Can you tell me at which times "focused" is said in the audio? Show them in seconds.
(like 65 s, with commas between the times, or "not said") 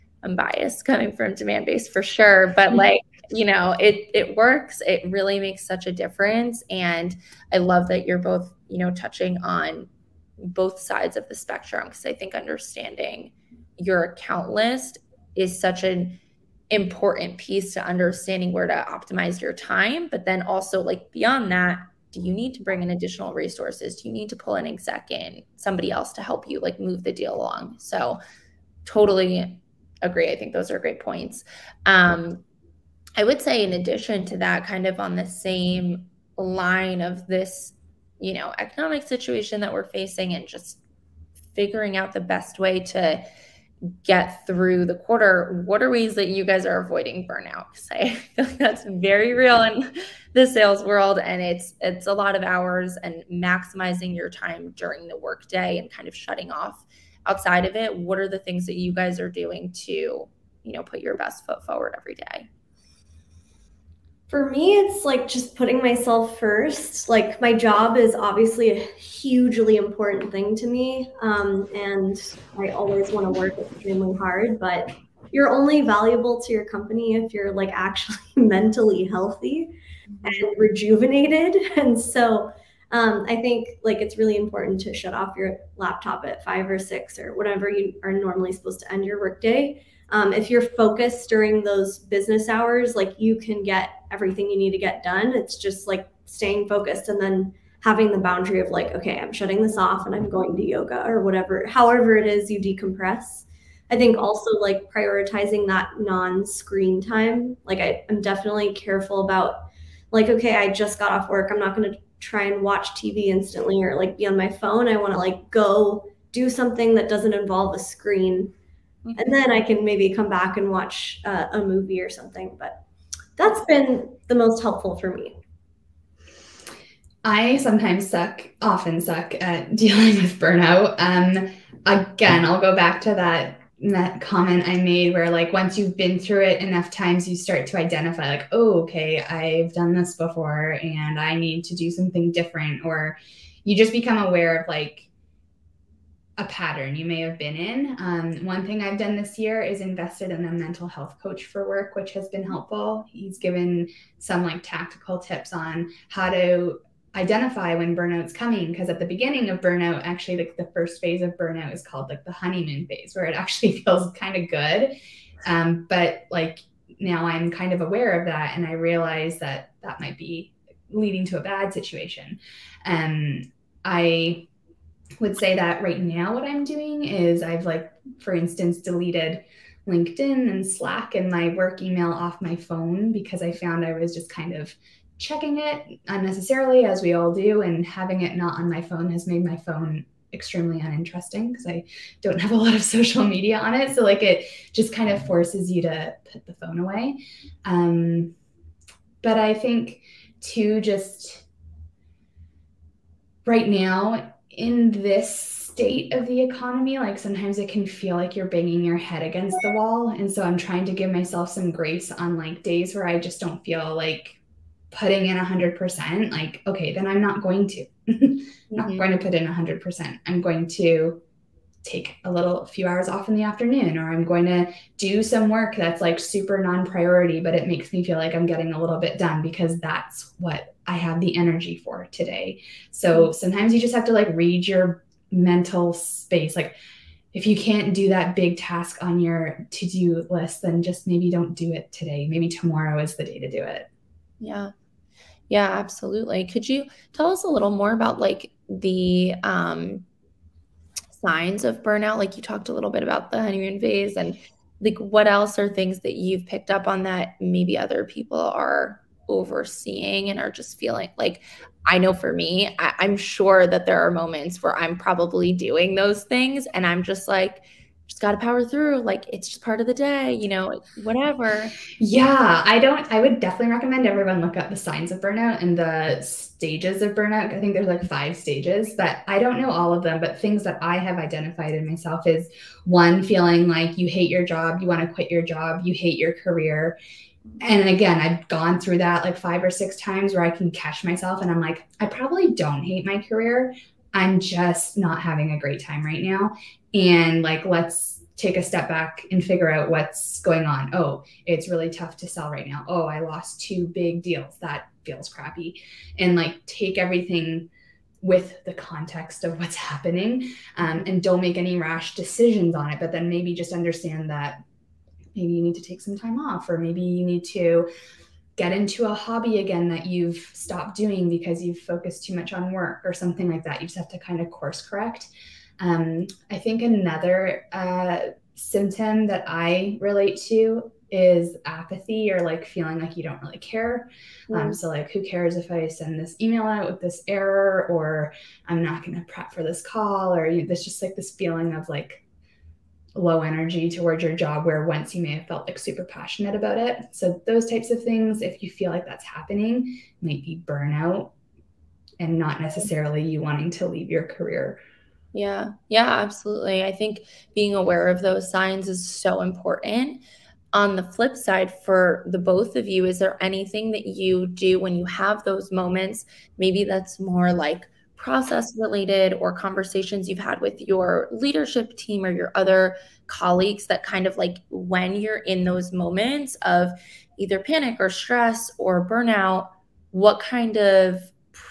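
90 s, 96 s, 321 s.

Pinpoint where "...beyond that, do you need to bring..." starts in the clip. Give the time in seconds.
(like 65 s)
21 s.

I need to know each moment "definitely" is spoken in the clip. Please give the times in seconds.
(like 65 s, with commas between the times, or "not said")
108 s, 273 s.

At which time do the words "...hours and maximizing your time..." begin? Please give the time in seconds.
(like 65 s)
52 s.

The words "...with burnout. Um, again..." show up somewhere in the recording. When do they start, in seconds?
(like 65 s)
130 s.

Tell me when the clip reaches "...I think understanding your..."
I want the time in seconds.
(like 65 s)
12 s.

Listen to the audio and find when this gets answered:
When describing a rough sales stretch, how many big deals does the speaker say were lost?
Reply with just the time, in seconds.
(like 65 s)
303 s.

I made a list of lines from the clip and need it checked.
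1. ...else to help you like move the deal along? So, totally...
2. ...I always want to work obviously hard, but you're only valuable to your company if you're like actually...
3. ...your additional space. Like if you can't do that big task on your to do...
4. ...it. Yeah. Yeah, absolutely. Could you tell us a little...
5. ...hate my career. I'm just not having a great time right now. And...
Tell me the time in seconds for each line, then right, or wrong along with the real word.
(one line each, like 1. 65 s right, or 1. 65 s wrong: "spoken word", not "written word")
1. 25 s right
2. 72 s wrong: "extremely", not "obviously"
3. 234 s wrong: "mental", not "additional"
4. 243 s right
5. 292 s right.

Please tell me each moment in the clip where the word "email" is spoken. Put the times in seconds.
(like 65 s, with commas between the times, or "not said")
181 s, 336 s.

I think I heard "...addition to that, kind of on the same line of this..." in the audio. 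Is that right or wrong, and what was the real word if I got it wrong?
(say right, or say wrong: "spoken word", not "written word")
right.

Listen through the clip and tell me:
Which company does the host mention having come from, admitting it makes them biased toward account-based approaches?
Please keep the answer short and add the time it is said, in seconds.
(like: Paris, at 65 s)
Demandbase, at 1 s.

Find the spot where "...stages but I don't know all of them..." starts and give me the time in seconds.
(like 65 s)
278 s.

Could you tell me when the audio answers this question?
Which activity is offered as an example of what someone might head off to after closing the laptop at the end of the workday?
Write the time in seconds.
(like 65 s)
100 s.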